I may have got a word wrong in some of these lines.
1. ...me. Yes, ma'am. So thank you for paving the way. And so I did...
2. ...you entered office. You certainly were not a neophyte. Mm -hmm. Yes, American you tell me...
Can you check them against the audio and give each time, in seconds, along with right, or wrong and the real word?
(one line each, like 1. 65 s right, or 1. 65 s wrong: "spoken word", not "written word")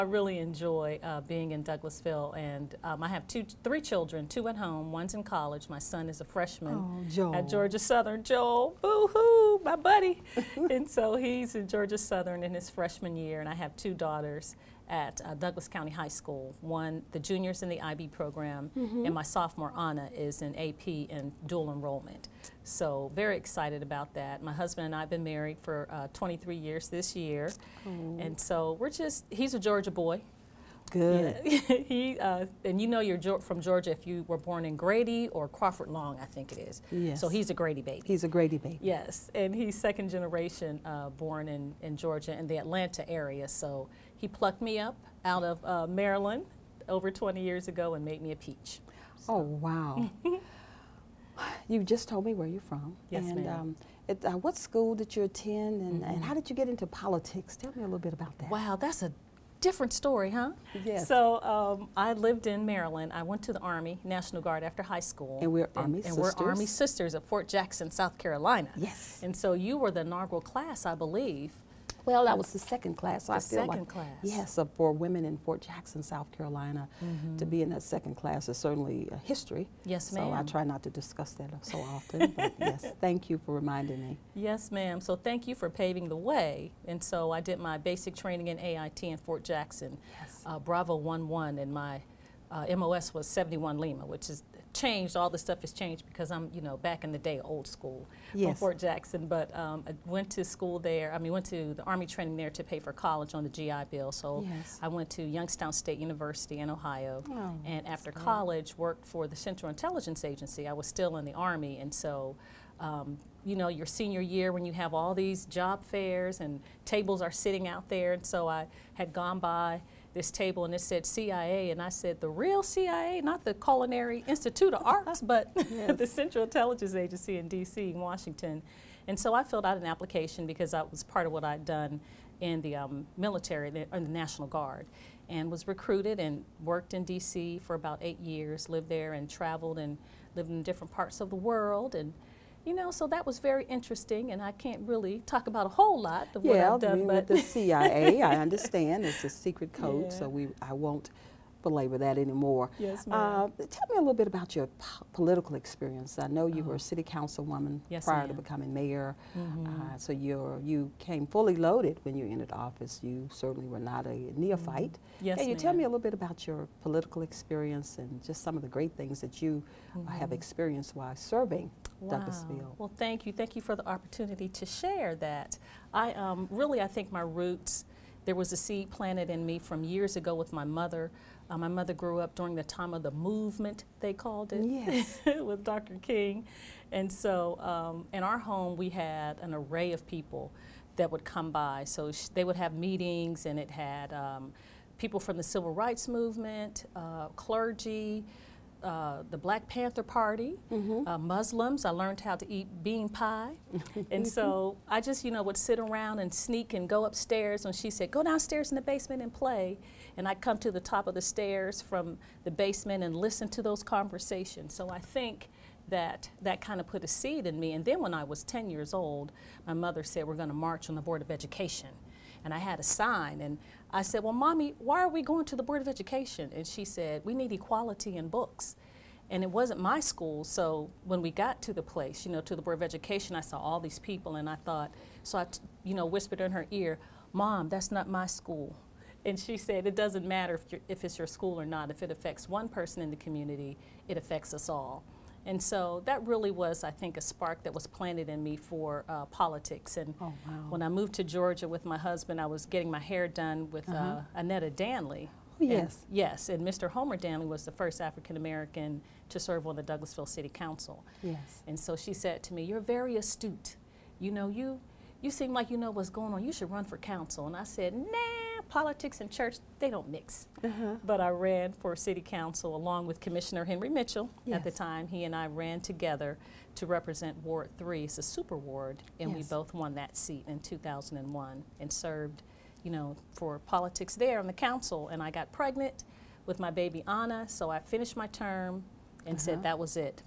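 1. 83 s right
2. 162 s wrong: "Can", not "American".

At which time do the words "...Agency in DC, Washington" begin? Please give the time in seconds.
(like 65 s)
126 s.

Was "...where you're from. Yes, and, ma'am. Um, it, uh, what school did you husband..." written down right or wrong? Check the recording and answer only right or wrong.
wrong.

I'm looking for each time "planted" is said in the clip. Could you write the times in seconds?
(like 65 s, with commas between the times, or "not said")
178 s, 247 s.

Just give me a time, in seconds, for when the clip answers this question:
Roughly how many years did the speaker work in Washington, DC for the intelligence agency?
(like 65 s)
138 s.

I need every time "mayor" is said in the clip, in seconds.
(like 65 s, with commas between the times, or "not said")
158 s.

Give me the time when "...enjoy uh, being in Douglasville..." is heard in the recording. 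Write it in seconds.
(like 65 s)
0 s.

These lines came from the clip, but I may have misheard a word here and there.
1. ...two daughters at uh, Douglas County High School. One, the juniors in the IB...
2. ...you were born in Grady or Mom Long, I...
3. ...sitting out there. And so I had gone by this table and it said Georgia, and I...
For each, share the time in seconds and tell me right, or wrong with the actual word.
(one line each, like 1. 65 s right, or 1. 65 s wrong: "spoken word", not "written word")
1. 13 s right
2. 34 s wrong: "Crawford", not "Mom"
3. 117 s wrong: "CIA", not "Georgia".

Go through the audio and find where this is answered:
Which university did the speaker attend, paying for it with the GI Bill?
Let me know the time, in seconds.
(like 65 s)
105 s.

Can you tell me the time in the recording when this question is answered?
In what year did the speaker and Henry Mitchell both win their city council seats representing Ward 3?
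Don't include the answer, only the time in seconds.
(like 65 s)
280 s.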